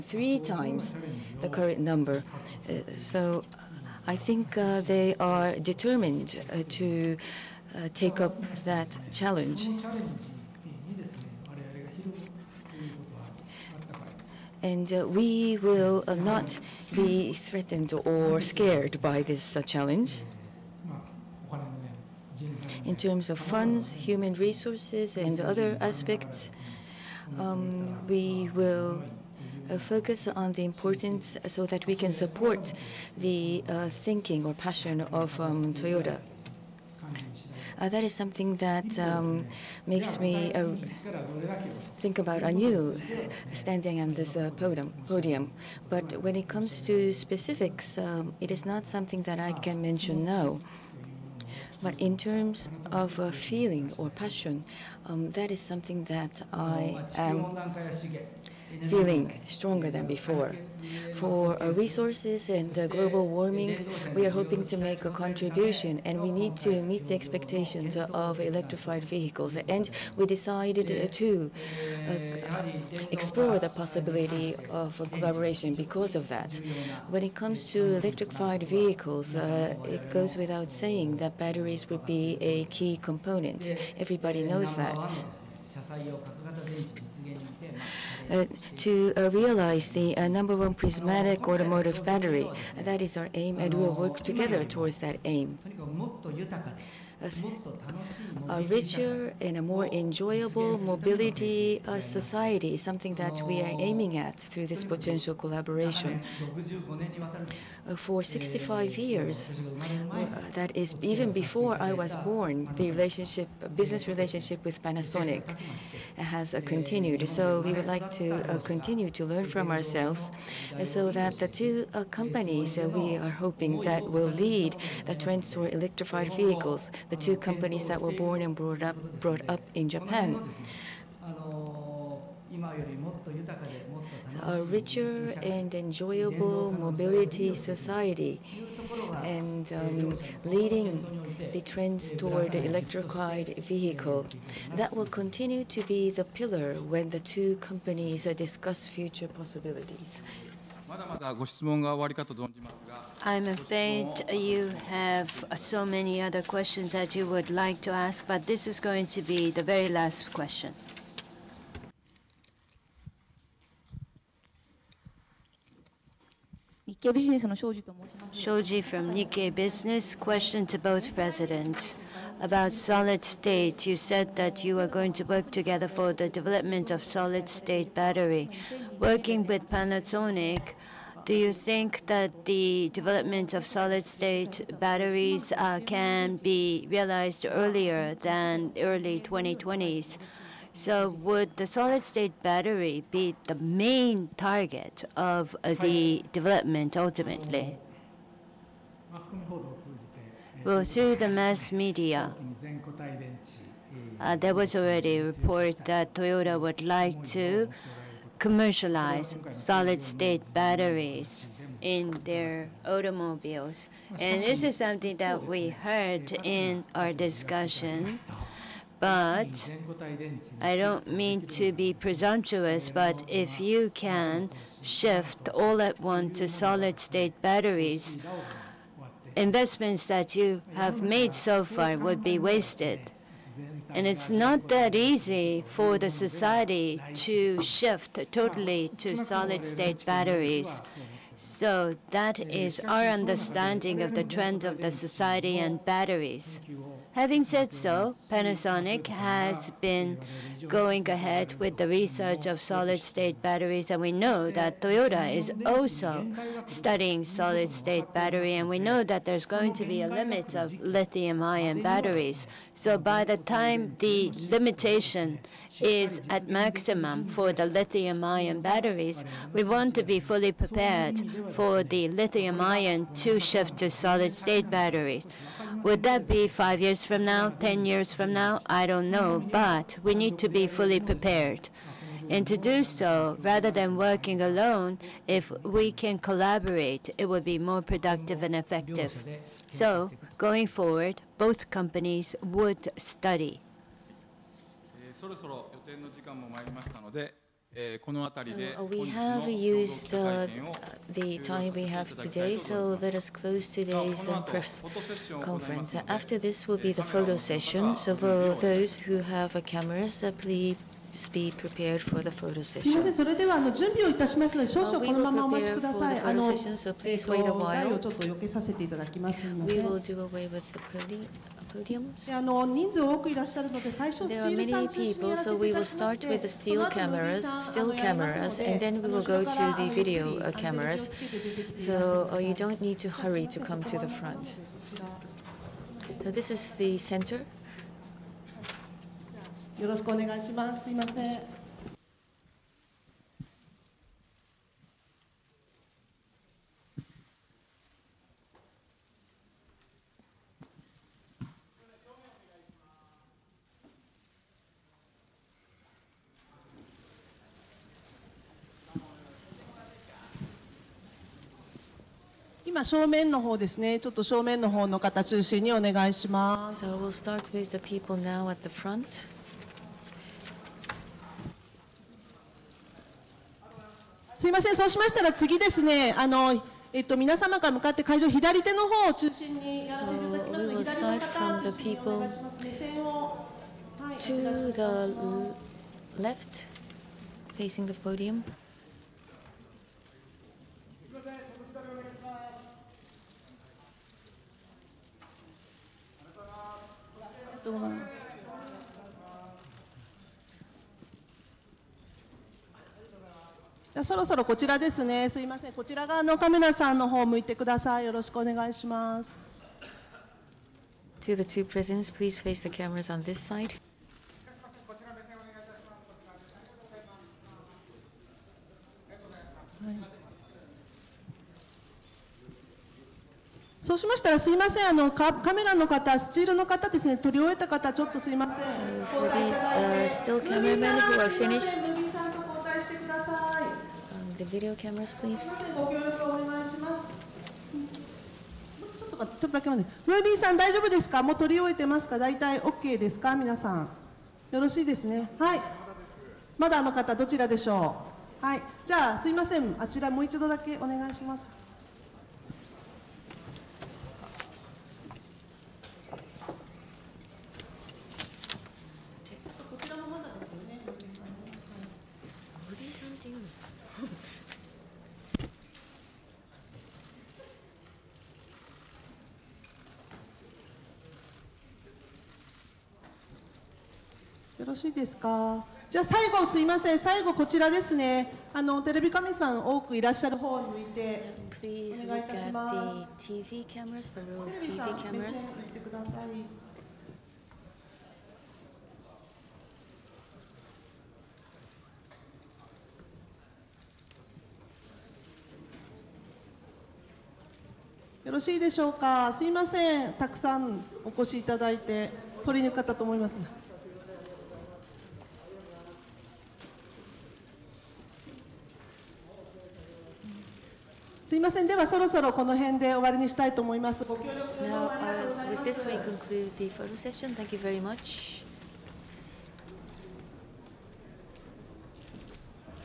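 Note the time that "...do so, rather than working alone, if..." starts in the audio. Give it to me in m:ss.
4:42.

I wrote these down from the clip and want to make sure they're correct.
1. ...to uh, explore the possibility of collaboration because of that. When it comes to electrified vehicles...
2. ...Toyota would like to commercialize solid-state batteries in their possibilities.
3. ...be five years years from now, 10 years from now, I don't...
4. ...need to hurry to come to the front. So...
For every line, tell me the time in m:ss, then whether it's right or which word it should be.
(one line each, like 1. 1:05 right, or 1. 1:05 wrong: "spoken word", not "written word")
1. 1:11 right
2. 3:26 wrong: "automobiles", not "possibilities"
3. 4:36 right
4. 5:32 right.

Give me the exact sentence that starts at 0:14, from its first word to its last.
and uh, we will uh, not be threatened or scared by this uh, challenge.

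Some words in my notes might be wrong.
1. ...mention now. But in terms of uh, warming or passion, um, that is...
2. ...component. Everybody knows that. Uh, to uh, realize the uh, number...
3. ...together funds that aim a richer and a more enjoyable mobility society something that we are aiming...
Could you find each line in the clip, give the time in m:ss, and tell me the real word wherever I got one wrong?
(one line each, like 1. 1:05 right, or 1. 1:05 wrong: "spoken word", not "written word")
1. 0:49 wrong: "feeling", not "warming"
2. 1:23 right
3. 1:34 wrong: "towards", not "funds".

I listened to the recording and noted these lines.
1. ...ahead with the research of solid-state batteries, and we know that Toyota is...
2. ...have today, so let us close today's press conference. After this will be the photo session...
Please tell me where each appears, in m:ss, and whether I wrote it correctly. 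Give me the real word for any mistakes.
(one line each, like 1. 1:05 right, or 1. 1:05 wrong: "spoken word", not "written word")
1. 4:11 right
2. 5:01 right.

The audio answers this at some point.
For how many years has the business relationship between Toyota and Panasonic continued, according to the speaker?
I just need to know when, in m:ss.
1:48.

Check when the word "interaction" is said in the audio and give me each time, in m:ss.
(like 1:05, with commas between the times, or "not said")
not said.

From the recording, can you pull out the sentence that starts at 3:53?
And it's not that easy for the society to shift totally to solid state batteries.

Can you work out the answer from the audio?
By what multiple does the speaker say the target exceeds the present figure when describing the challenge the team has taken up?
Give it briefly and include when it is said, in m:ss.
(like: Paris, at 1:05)
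three times, at 0:00.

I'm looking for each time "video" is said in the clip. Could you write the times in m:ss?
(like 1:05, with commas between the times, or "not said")
5:29, 7:14.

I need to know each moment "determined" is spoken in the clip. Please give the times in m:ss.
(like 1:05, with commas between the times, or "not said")
0:05.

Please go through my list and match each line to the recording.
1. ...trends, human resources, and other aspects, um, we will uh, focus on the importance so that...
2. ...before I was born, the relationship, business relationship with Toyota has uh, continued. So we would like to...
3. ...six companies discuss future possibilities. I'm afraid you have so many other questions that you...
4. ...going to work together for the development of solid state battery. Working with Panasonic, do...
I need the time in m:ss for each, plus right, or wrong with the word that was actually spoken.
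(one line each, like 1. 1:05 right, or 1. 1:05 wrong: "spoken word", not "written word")
1. 0:23 wrong: "funds", not "trends"
2. 1:51 wrong: "Panasonic", not "Toyota"
3. 2:27 wrong: "two", not "six"
4. 2:54 right.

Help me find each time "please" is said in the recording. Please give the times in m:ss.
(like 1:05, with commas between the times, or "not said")
5:10, 5:16, 6:52, 7:15.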